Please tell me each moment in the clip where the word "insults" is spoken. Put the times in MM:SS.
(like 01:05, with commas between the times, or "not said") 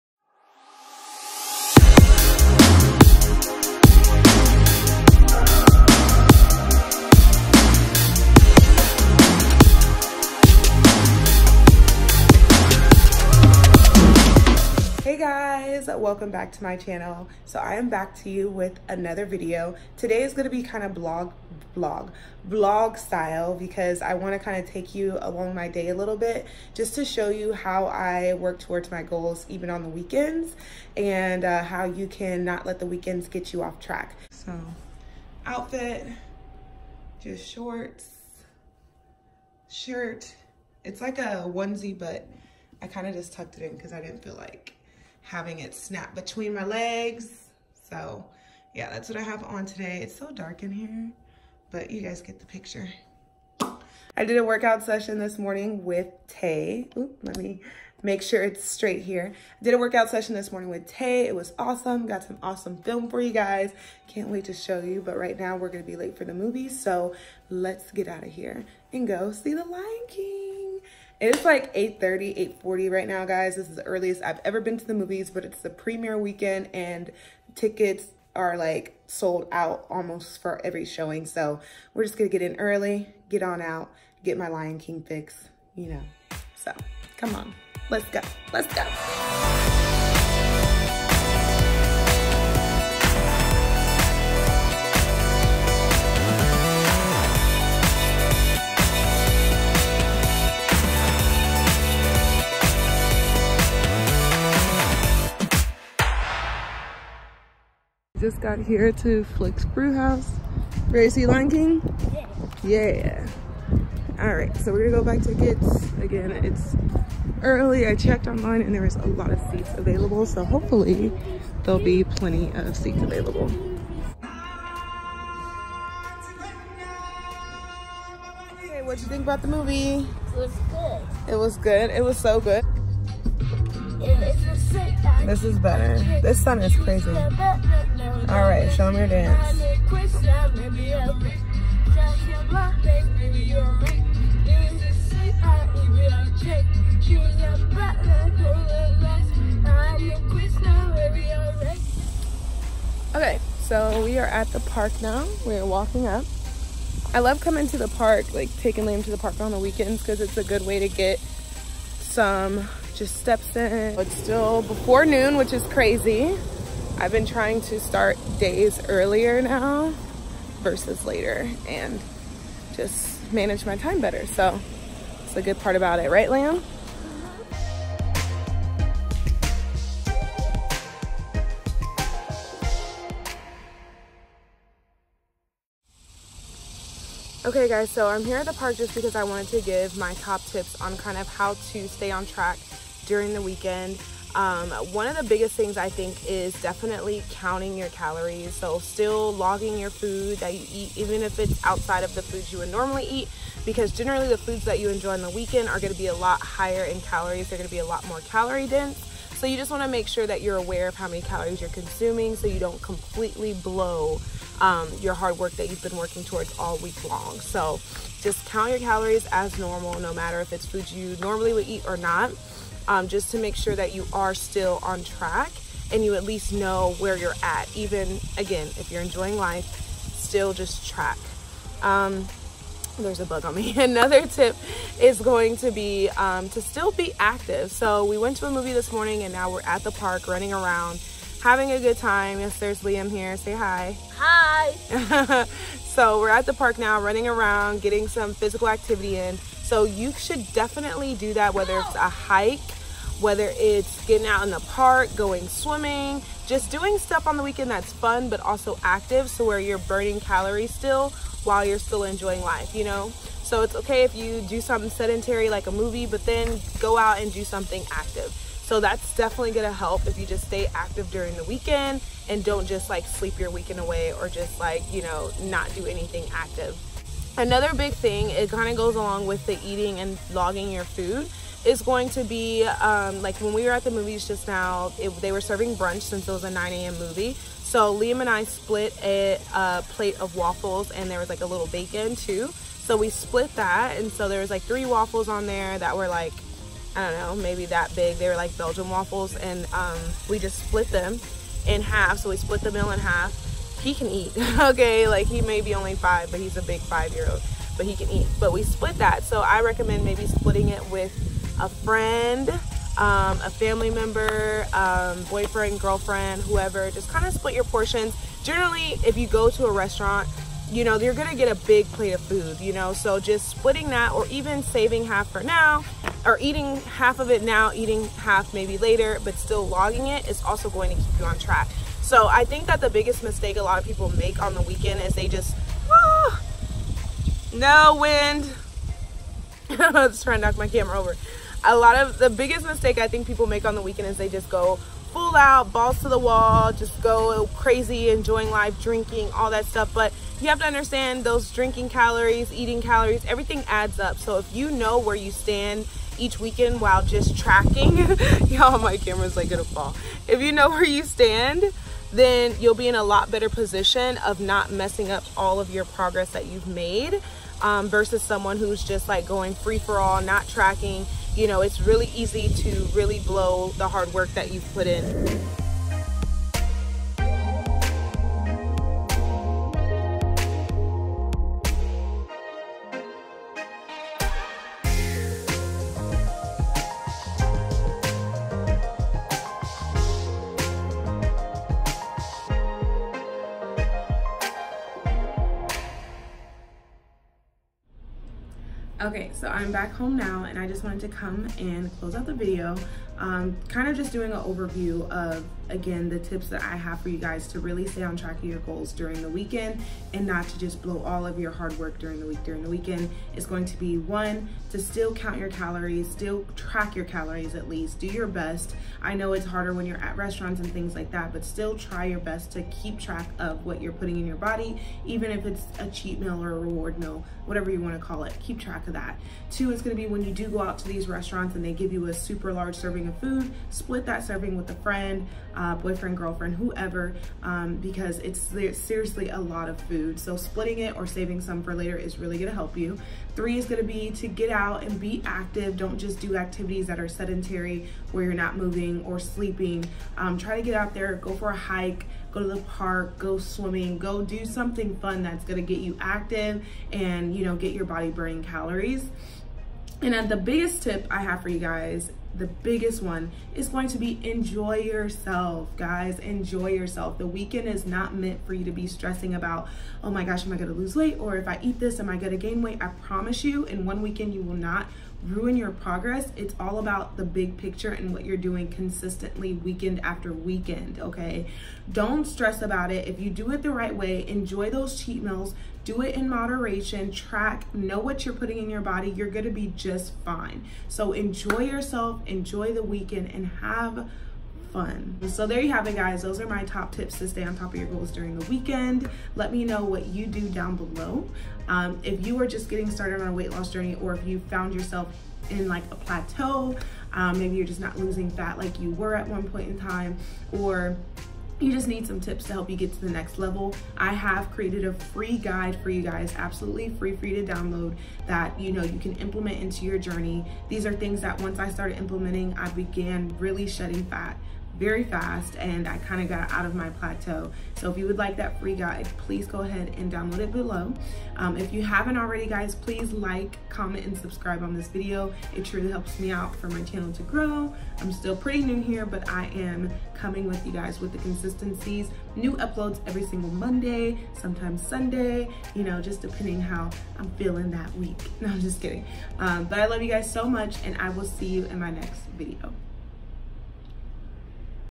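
not said.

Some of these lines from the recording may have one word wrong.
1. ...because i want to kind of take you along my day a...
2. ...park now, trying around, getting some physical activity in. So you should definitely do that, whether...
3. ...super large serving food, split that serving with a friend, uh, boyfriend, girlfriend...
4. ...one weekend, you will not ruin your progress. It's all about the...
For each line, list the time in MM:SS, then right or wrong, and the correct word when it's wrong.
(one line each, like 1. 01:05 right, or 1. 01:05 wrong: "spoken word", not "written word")
1. 00:23 right
2. 04:06 wrong: "running", not "trying"
3. 07:12 right
4. 07:53 right.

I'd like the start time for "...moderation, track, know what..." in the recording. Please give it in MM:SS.
08:06.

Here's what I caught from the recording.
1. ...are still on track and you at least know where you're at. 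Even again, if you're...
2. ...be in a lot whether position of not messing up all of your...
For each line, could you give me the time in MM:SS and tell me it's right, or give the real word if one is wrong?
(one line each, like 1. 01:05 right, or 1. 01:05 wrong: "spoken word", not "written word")
1. 03:44 right
2. 06:02 wrong: "better", not "whether".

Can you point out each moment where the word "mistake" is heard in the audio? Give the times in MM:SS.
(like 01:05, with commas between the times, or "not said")
05:33, 05:42.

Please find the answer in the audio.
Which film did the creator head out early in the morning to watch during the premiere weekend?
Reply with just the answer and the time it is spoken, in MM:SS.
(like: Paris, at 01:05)
The Lion King, at 01:09.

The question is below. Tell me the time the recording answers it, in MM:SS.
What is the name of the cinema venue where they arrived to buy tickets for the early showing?
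01:49.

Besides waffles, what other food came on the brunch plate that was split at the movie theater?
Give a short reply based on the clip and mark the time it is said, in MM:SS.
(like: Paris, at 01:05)
bacon, at 04:51.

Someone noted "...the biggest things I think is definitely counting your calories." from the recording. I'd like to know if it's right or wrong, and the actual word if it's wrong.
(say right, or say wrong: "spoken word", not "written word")
right.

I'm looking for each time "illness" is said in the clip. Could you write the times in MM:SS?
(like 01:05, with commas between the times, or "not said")
not said.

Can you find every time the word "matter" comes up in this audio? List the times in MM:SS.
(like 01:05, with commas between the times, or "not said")
03:40.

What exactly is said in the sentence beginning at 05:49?
But you have to understand those drinking calories, eating calories, everything adds up.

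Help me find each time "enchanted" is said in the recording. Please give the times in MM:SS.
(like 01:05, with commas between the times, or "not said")
not said.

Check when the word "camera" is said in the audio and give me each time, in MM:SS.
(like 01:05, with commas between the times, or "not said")
05:40, 05:58.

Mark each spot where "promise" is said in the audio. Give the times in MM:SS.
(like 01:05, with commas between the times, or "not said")
07:53.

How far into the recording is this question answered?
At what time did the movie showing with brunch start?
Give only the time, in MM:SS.
04:46.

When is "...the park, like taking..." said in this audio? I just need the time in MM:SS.
02:37.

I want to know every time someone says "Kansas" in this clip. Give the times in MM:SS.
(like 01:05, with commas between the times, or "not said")
not said.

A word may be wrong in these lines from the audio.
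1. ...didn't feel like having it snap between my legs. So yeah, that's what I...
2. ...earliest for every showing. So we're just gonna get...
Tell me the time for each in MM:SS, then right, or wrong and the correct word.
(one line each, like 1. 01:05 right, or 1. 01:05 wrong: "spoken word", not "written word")
1. 00:44 right
2. 01:19 wrong: "almost", not "earliest".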